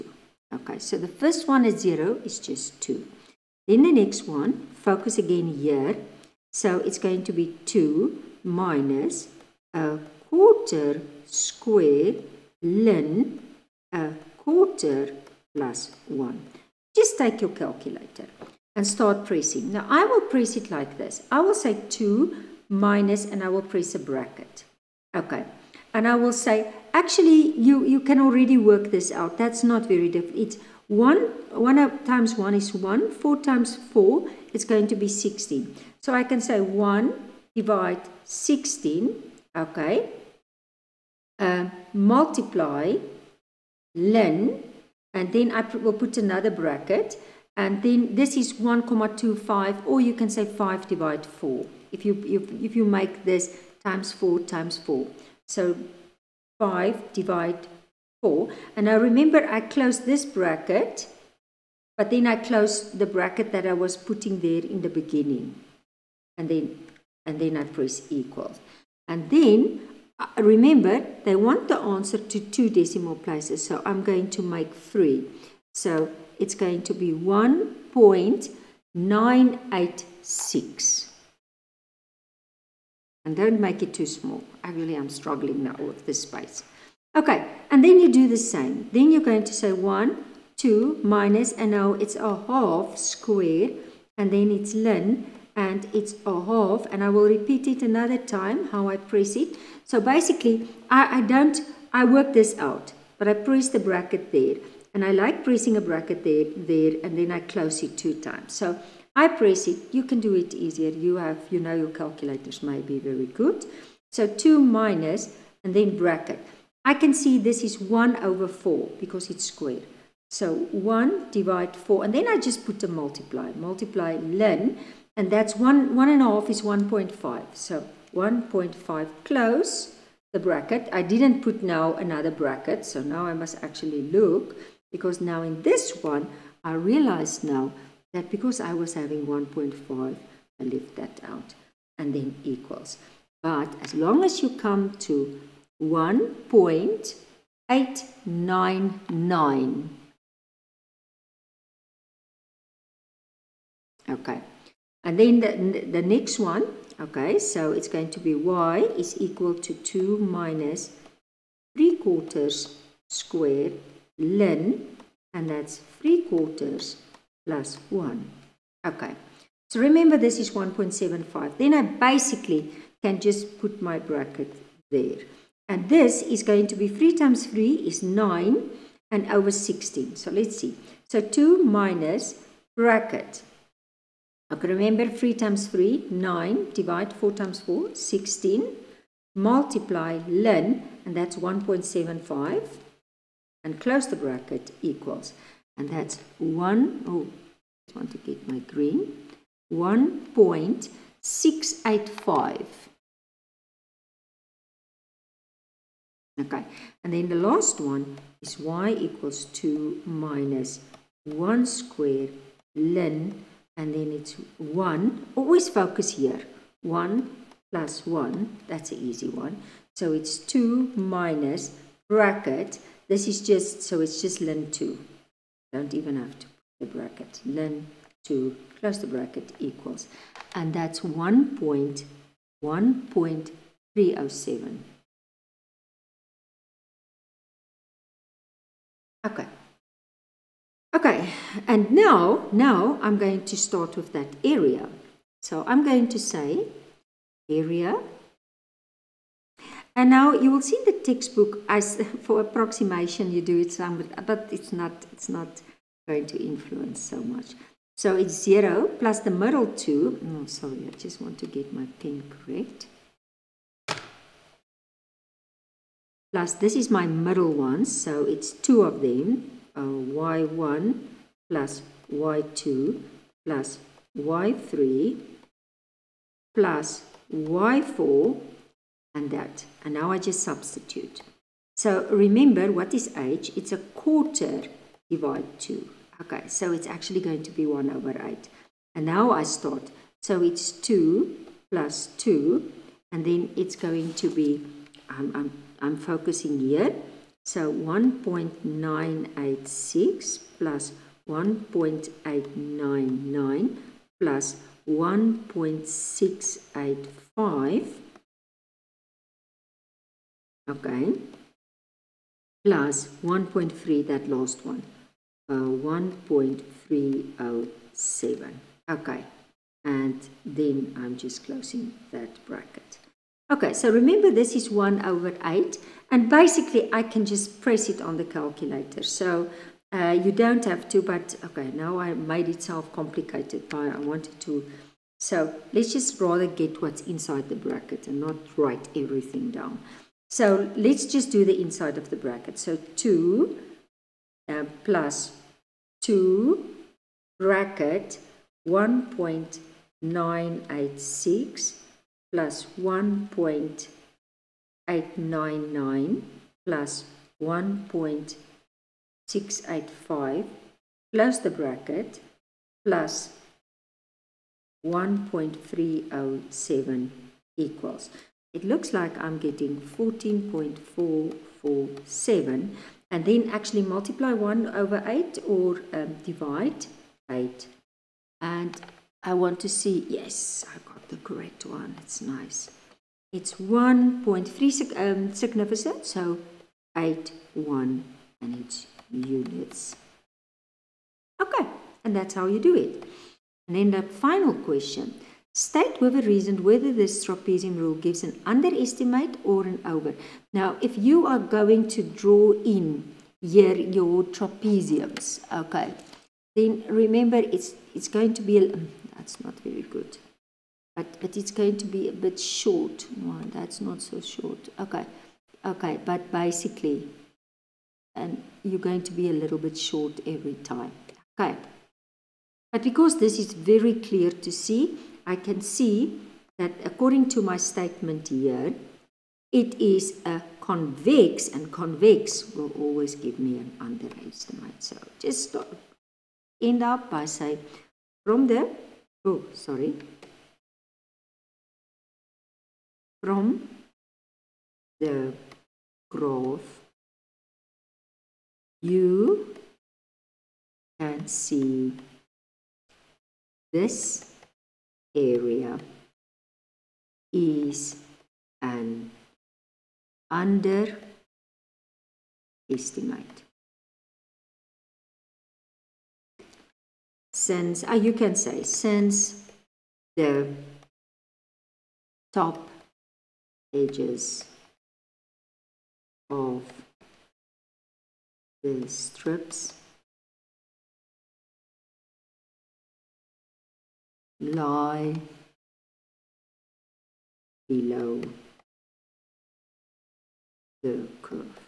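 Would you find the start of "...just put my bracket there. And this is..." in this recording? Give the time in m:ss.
2:53.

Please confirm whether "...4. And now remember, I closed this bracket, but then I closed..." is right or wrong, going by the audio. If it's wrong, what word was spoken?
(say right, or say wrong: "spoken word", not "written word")
right.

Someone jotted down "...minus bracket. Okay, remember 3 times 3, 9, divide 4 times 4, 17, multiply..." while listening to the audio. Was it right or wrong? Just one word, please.
wrong.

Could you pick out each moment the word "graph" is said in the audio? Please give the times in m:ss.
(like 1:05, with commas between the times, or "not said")
7:26.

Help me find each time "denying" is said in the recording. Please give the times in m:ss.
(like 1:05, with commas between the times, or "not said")
not said.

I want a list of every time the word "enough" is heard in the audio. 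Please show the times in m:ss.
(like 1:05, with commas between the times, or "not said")
not said.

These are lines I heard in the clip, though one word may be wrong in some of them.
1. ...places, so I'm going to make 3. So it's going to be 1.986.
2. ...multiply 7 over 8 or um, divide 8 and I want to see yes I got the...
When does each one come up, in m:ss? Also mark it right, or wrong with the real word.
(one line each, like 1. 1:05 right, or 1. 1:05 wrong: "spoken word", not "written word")
1. 1:13 right
2. 6:13 wrong: "1", not "7".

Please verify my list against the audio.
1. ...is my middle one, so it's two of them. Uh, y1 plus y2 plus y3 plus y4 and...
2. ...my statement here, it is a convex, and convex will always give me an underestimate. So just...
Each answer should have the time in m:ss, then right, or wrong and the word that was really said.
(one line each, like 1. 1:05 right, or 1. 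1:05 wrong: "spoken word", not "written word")
1. 4:26 right
2. 7:07 right.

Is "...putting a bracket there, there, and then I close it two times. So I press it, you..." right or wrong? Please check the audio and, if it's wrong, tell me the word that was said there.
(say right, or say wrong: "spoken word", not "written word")
wrong: "pressing", not "putting".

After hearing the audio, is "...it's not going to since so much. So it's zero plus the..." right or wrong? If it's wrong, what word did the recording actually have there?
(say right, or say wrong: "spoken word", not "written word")
wrong: "influence", not "since".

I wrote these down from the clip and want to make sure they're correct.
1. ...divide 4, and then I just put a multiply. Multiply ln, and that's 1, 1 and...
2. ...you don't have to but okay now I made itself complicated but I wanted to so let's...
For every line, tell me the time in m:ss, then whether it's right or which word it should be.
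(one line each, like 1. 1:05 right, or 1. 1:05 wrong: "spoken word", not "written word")
1. 2:01 right
2. 5:30 right.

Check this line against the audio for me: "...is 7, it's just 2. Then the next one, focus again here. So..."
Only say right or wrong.
wrong.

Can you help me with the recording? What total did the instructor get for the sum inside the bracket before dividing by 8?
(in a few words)
14.447.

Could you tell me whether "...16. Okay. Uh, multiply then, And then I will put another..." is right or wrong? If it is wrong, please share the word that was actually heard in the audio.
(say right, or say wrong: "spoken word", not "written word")
right.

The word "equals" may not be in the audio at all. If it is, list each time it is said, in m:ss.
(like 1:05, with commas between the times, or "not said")
1:08, 2:22, 2:39, 3:14, 3:28, 3:49.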